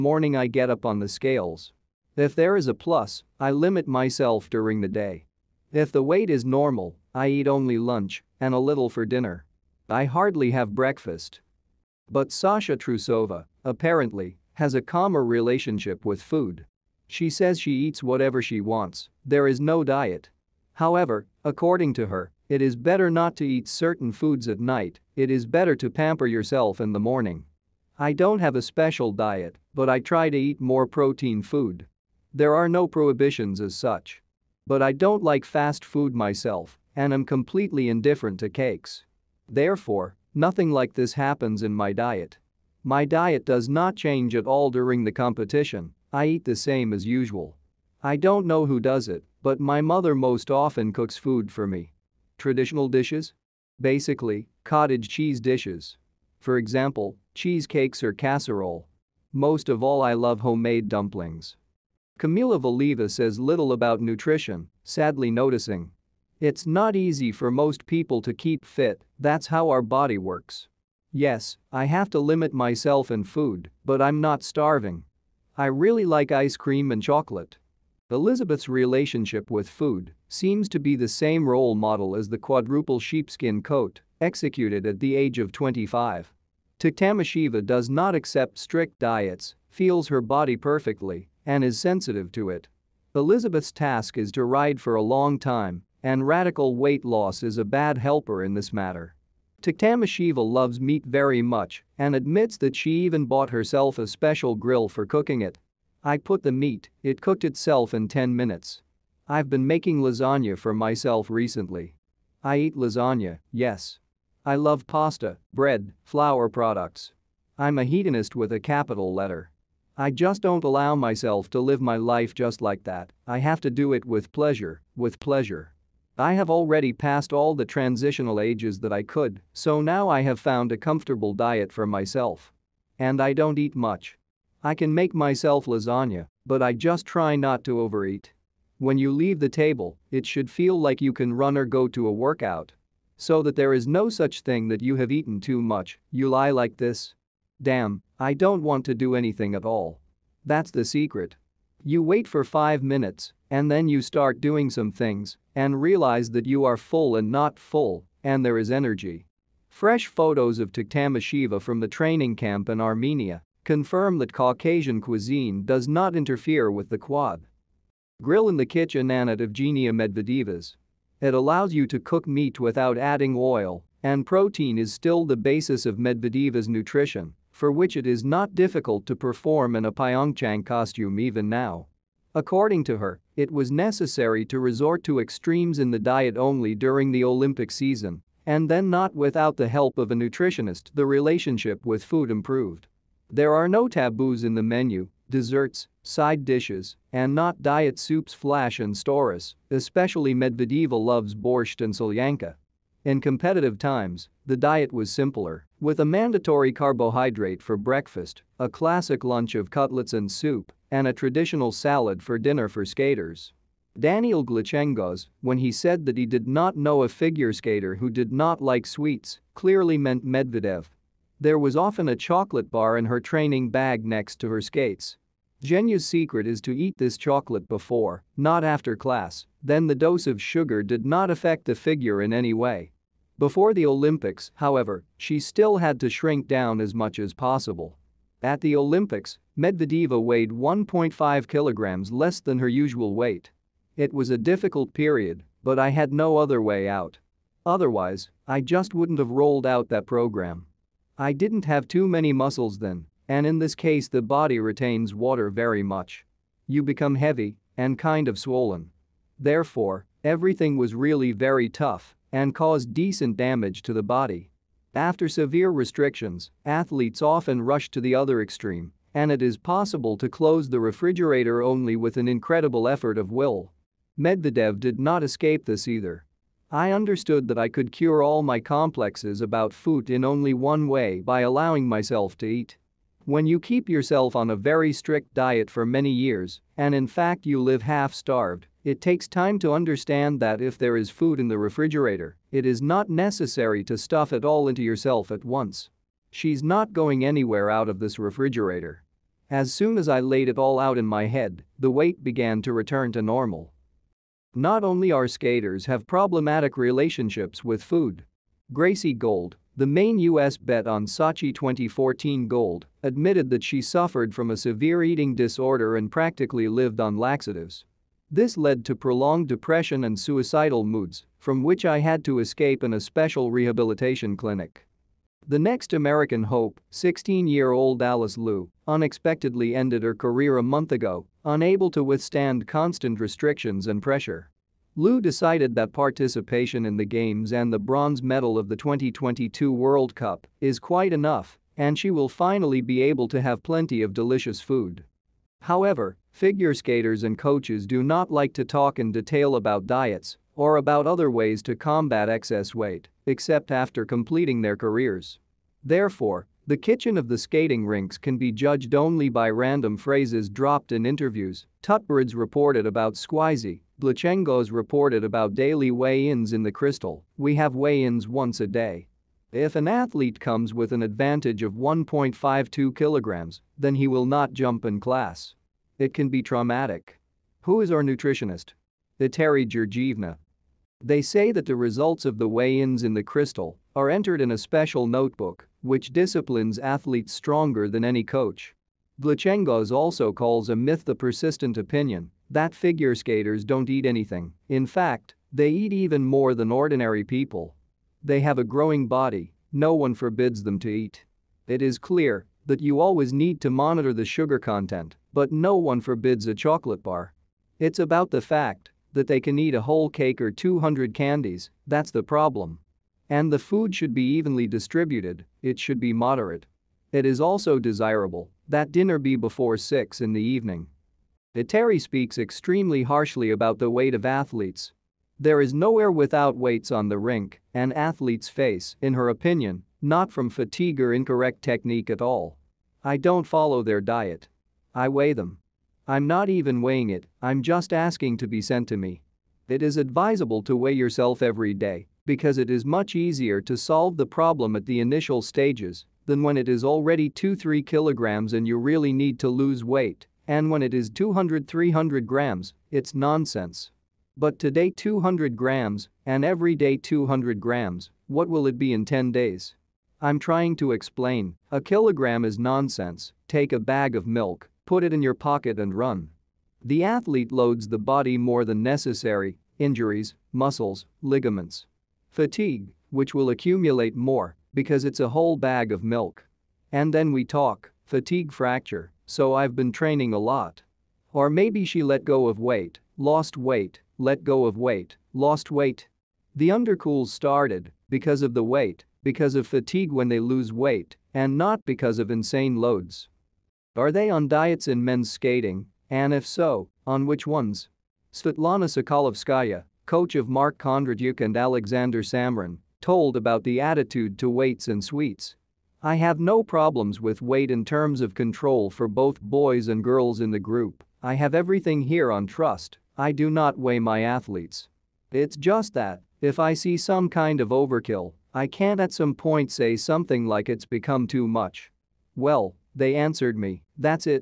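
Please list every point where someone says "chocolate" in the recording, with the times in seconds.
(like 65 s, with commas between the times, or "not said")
77 s, 222 s, 227 s, 406 s.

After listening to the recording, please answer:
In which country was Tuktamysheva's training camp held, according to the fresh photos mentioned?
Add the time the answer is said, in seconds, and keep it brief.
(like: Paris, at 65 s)
Armenia, at 162 s.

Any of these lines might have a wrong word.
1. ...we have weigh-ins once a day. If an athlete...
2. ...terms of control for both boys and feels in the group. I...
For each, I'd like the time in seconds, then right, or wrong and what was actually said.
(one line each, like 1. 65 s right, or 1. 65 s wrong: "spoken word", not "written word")
1. 367 s right
2. 507 s wrong: "girls", not "feels".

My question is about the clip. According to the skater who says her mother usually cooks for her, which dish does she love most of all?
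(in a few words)
homemade dumplings.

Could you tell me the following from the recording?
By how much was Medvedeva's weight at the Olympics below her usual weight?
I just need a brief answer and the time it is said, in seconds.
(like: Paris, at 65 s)
1.5 kg, at 240 s.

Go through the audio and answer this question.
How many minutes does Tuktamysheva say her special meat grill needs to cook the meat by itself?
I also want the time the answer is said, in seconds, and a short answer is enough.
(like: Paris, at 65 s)
10 minutes, at 108 s.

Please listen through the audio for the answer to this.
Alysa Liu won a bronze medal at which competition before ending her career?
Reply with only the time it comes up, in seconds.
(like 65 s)
338 s.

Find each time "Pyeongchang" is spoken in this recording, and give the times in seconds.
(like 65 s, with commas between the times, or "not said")
179 s.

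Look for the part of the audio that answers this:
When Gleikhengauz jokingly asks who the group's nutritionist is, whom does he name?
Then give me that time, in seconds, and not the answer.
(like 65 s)
379 s.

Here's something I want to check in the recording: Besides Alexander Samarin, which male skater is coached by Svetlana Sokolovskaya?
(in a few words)
Mark Kondratyuk.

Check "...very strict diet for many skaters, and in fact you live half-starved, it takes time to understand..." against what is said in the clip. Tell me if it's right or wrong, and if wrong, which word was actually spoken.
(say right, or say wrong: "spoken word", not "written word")
wrong: "years", not "skaters".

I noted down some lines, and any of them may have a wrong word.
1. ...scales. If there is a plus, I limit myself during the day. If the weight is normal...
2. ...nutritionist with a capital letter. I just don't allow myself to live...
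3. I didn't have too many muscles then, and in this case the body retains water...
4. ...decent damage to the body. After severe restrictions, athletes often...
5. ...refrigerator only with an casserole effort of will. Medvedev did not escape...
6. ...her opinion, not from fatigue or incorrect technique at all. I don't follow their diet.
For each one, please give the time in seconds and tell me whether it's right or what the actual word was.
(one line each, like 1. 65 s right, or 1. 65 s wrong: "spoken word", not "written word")
1. 1 s right
2. 117 s wrong: "hedonist", not "nutritionist"
3. 251 s right
4. 262 s right
5. 270 s wrong: "incredible", not "casserole"
6. 429 s right.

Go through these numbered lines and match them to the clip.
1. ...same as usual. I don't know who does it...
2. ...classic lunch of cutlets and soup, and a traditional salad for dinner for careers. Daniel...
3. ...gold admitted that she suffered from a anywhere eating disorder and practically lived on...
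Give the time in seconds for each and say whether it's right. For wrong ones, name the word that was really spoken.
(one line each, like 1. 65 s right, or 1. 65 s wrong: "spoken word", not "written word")
1. 46 s right
2. 208 s wrong: "skaters", not "careers"
3. 312 s wrong: "severe", not "anywhere".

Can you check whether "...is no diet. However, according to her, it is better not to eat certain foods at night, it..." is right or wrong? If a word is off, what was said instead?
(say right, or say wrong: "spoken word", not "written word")
right.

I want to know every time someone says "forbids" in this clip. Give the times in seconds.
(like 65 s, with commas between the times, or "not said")
400 s, 406 s.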